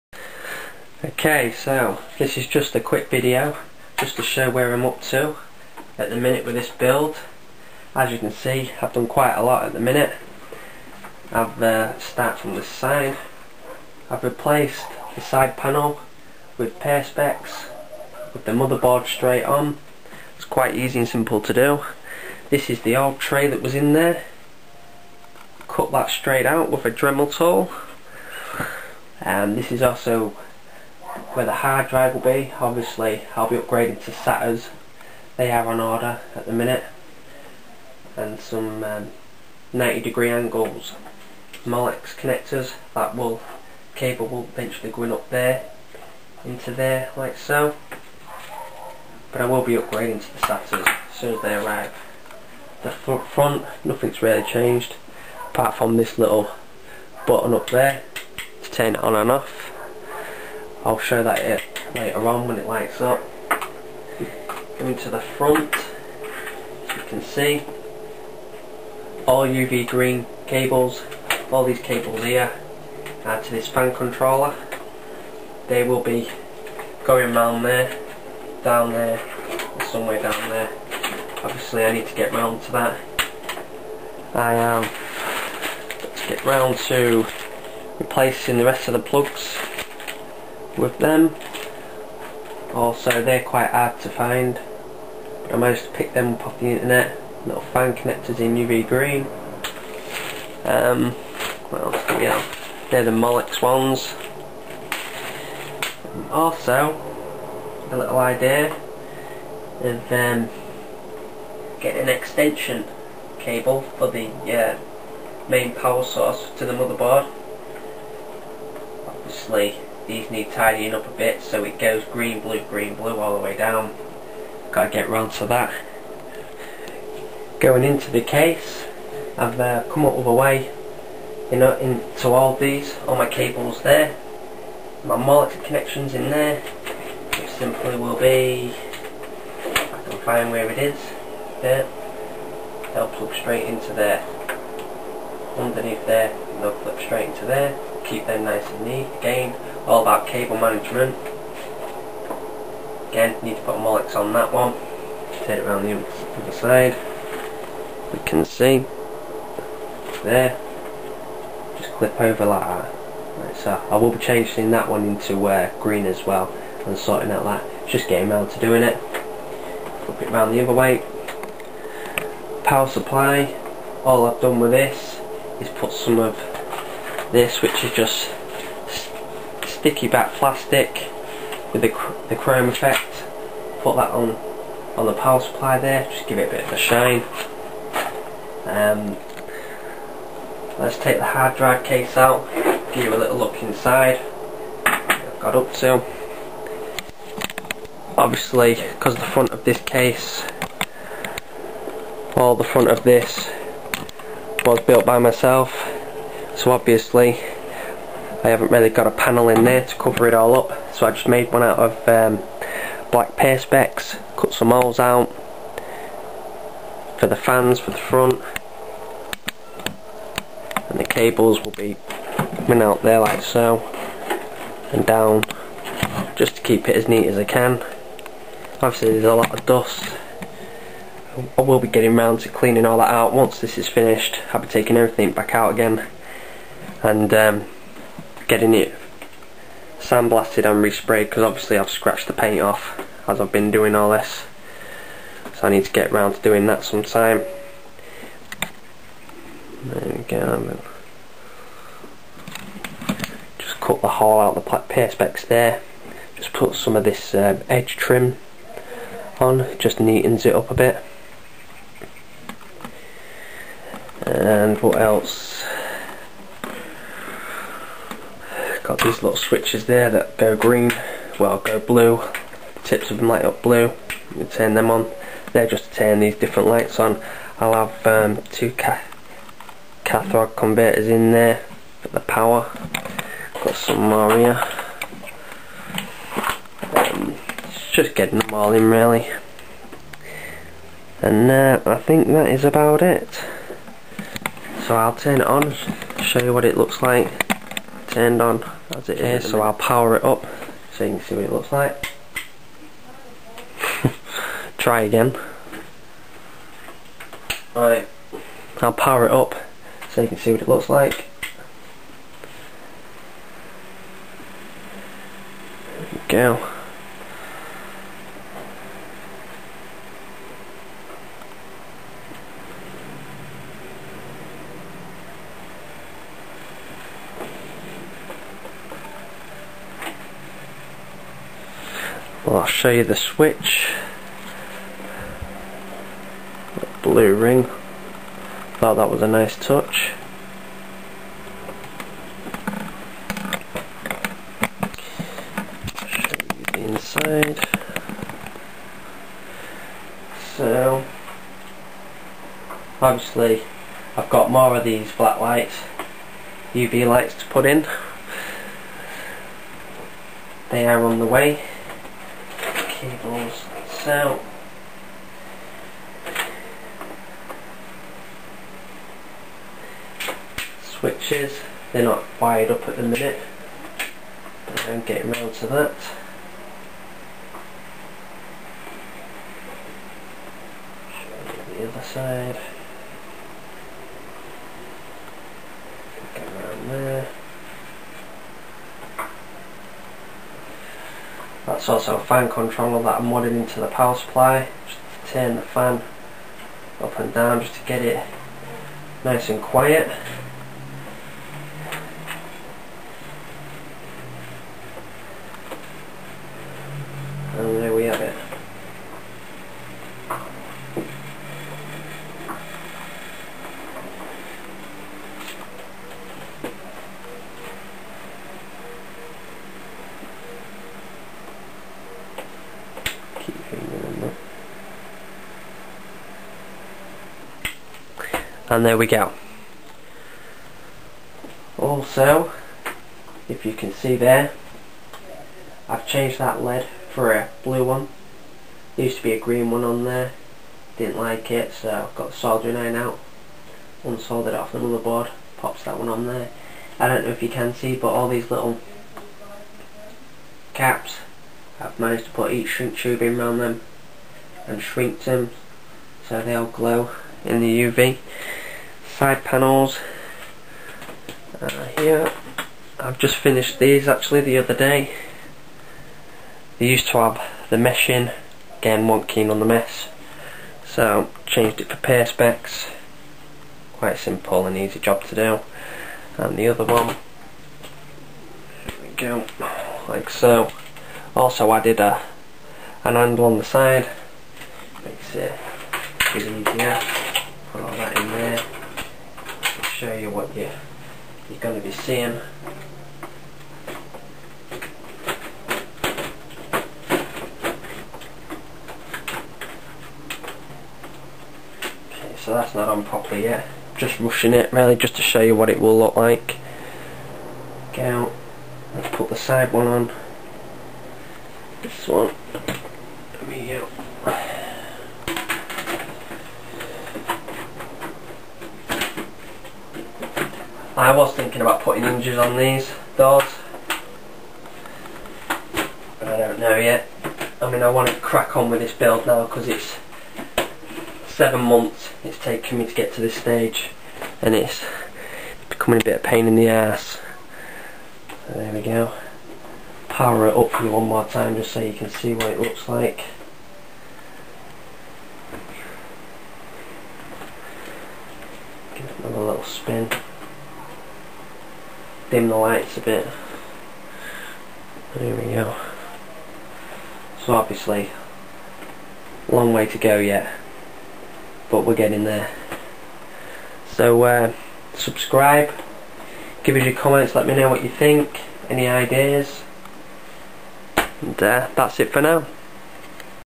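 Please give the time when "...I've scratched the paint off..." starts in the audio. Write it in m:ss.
4:01.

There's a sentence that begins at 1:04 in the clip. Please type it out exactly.
Going to the front, as you can see, all UV green cables, all these cables here, add to this fan controller.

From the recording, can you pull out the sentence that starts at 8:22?
Okay, so that's not on properly yet.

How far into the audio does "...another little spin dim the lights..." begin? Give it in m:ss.
9:09.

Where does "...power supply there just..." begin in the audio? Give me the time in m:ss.
3:05.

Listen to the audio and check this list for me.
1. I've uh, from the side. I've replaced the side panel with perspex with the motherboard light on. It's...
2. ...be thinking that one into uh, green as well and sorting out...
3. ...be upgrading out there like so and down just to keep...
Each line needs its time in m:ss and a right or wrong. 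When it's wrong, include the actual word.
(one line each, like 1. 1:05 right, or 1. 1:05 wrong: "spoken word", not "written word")
1. 0:11 wrong: "straight", not "light"
2. 2:44 wrong: "changing", not "thinking"
3. 3:41 wrong: "coming", not "upgrading".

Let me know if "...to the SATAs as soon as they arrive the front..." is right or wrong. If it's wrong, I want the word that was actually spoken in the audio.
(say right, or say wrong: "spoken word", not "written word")
right.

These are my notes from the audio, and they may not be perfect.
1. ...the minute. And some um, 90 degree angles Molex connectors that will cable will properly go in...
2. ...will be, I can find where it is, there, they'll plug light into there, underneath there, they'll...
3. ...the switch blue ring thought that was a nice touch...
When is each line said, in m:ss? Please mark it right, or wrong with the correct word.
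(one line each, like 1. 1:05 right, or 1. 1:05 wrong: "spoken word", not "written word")
1. 0:36 wrong: "eventually", not "properly"
2. 2:17 wrong: "straight", not "light"
3. 5:33 right.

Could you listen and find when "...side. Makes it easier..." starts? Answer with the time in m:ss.
8:03.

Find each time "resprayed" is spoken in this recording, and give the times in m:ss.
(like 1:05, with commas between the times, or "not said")
4:00.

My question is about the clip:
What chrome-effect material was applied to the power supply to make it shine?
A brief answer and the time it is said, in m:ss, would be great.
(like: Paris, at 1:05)
Sticky back plastic, at 2:59.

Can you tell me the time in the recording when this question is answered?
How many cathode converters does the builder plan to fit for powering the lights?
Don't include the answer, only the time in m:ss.
4:38.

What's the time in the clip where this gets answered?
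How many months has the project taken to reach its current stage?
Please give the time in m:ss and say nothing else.
8:51.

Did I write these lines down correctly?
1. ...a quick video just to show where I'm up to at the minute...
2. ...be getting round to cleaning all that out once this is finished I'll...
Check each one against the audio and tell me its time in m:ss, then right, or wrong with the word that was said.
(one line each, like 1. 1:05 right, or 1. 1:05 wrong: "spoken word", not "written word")
1. 0:02 right
2. 3:51 right.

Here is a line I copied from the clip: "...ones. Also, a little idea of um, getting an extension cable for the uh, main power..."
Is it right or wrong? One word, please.
right.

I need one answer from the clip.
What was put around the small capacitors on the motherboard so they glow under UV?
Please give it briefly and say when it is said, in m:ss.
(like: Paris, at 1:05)
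Heat shrink tube, at 7:32.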